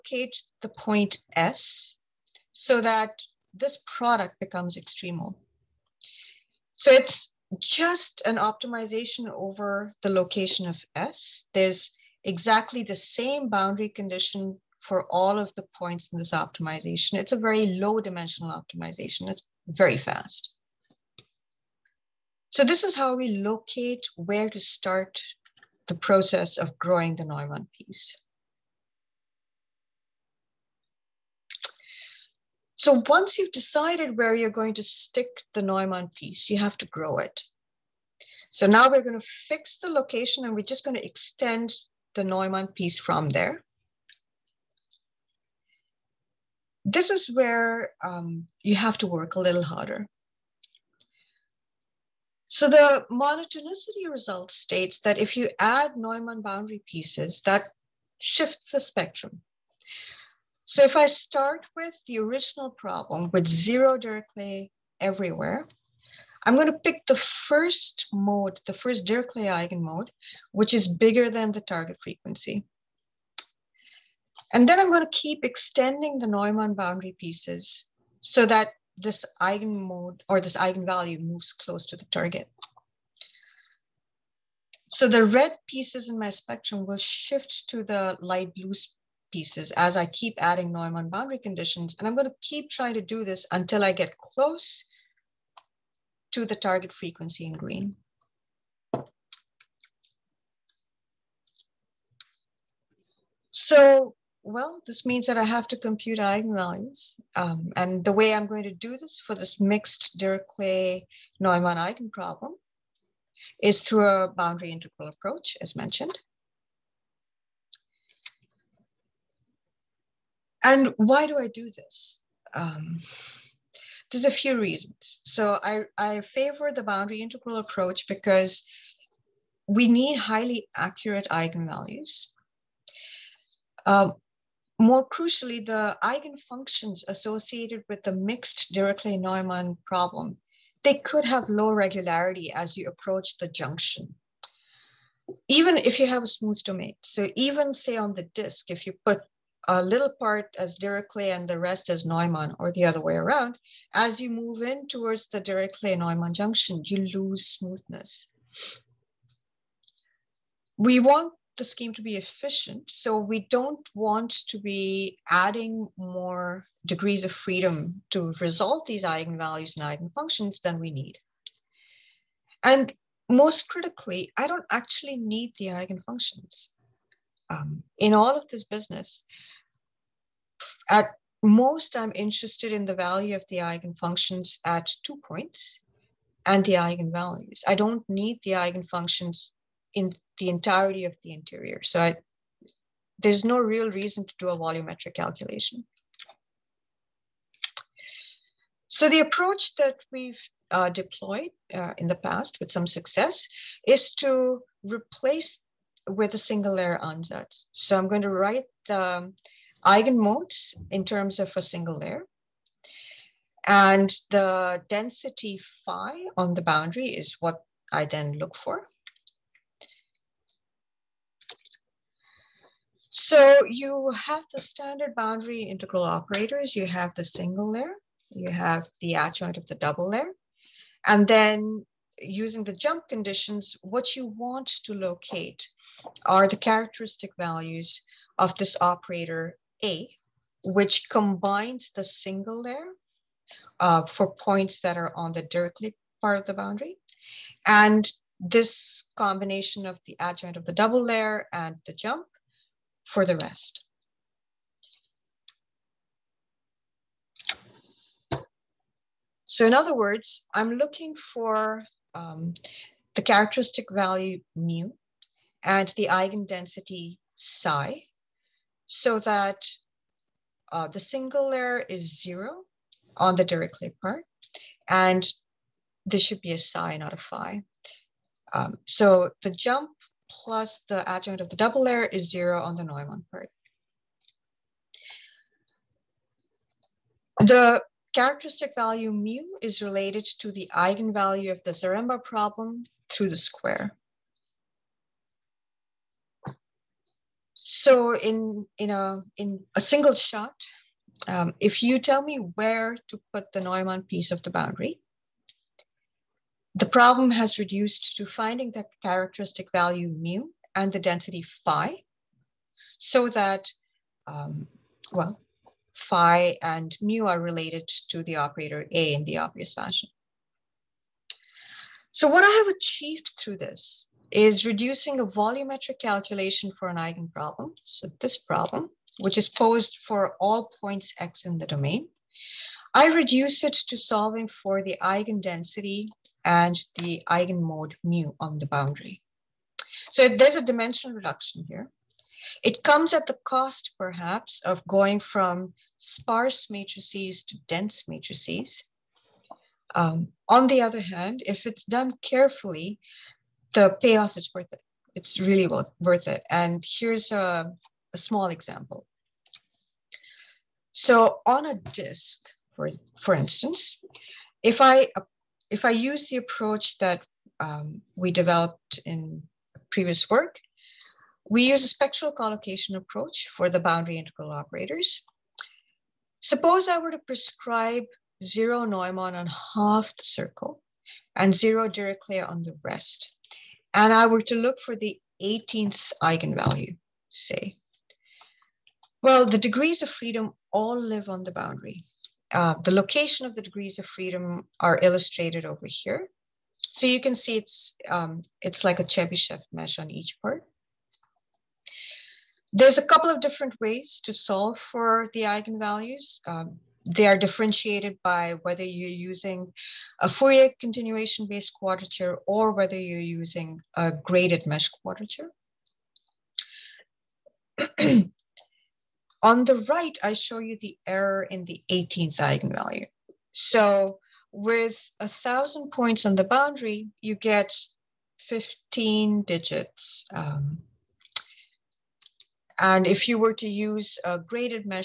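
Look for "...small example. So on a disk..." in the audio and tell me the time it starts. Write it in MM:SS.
05:58.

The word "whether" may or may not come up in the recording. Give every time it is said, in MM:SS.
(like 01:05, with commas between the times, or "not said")
06:48, 06:52.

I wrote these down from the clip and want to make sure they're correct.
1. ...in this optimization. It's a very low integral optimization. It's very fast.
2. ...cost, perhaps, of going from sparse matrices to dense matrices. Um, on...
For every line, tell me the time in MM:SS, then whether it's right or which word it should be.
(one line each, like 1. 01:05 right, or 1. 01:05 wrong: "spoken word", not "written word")
1. 00:16 wrong: "dimensional", not "integral"
2. 05:43 right.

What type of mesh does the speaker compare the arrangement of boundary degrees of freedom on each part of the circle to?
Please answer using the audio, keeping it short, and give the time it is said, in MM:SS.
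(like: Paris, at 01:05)
Chebyshev mesh, at 06:39.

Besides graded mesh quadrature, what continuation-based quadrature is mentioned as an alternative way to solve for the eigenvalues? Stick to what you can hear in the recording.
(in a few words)
Fourier continuation.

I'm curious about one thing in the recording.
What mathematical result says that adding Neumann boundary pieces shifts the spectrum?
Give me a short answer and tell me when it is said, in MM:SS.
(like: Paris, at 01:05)
Monotonicity result, at 00:53.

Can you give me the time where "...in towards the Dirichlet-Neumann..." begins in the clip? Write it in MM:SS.
02:34.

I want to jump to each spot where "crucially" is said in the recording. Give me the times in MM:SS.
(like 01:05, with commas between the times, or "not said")
02:15.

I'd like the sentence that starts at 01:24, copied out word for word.
So the red pieces in my spectrum will shift to the light blue pieces as I keep adding Neumann boundary conditions.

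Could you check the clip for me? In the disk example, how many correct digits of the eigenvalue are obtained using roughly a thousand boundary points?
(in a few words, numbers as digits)
15.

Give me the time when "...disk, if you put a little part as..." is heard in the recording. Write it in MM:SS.
02:28.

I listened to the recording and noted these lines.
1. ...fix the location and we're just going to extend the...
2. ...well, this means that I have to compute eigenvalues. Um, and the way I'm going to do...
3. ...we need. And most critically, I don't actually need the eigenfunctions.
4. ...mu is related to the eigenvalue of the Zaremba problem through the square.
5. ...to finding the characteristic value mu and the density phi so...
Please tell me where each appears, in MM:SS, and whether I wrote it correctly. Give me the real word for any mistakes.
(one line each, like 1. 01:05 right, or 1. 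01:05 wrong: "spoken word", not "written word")
1. 00:39 right
2. 01:44 right
3. 02:50 right
4. 04:49 right
5. 05:08 right.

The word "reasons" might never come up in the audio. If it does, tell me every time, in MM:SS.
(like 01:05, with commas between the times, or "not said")
02:04, 03:13.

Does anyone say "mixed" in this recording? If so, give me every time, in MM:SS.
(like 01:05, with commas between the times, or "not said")
01:49, 02:18.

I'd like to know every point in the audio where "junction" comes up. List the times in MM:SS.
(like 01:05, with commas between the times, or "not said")
02:23, 02:36.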